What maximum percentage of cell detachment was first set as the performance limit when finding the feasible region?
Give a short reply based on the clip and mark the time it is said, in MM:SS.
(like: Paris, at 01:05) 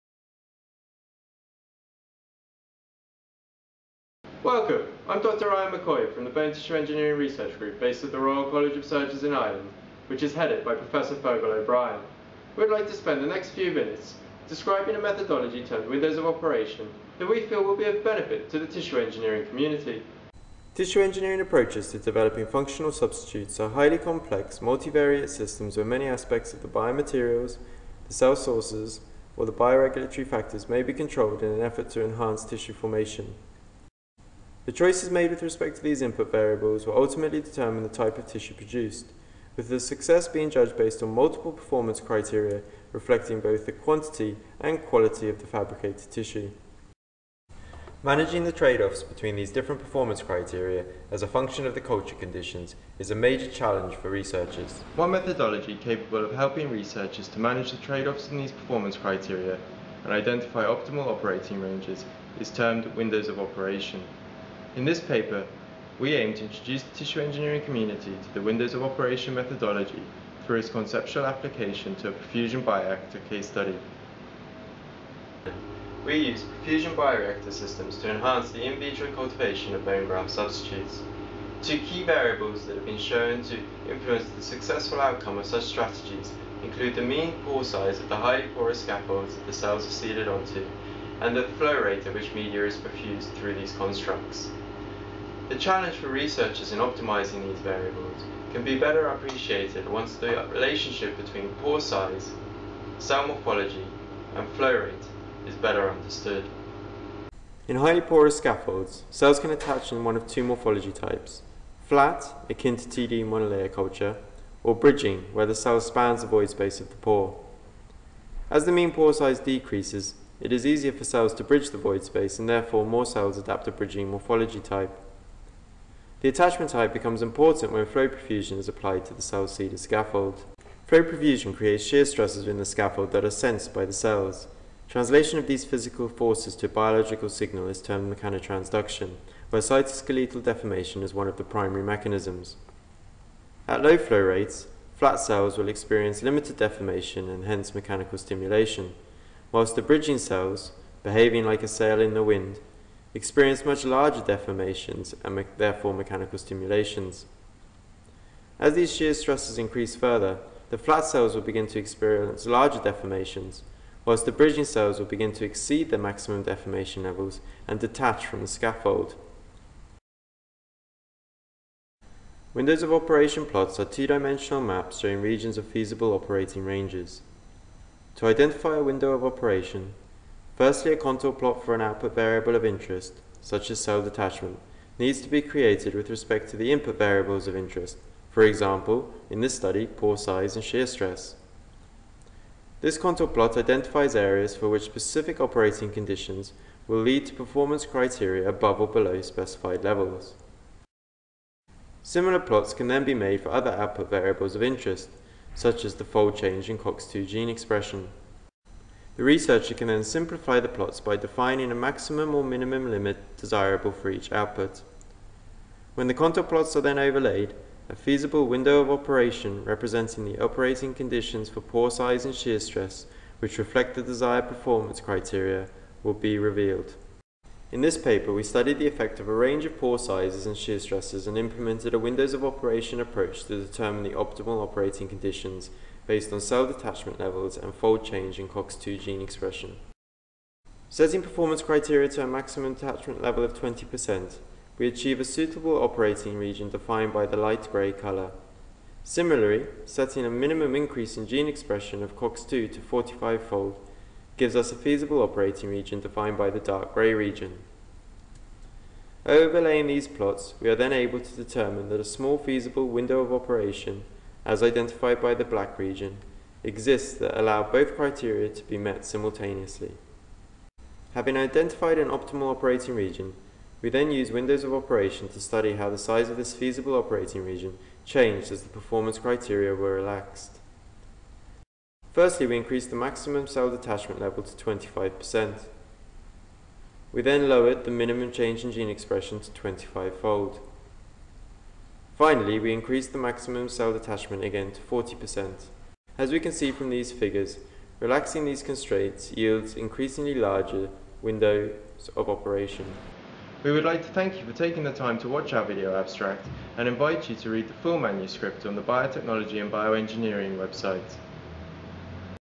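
20%, at 04:03.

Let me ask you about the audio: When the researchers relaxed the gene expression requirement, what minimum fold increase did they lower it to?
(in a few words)
25-fold.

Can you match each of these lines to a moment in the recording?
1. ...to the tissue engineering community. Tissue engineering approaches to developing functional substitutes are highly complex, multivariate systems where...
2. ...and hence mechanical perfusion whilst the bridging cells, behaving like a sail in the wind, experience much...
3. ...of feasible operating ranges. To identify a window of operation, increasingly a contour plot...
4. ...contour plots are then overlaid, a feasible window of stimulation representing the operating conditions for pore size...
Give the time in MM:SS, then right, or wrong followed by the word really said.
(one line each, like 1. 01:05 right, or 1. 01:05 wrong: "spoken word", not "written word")
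1. 00:18 right
2. 02:27 wrong: "stimulation", not "perfusion"
3. 02:55 wrong: "firstly", not "increasingly"
4. 03:36 wrong: "operation", not "stimulation".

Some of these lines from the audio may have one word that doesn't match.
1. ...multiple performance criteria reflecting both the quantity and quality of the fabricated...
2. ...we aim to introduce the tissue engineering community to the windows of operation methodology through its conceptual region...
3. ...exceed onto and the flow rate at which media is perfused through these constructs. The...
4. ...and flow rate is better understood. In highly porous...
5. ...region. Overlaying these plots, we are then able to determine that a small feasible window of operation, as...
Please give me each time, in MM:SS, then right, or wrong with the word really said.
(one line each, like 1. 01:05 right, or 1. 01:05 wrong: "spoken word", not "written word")
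1. 00:41 right
2. 01:05 wrong: "application", not "region"
3. 01:29 wrong: "seeded", not "exceed"
4. 01:44 right
5. 04:17 right.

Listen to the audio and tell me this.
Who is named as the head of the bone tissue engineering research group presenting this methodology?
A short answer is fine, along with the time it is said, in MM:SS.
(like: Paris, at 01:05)
Fergal O'Brien, at 00:10.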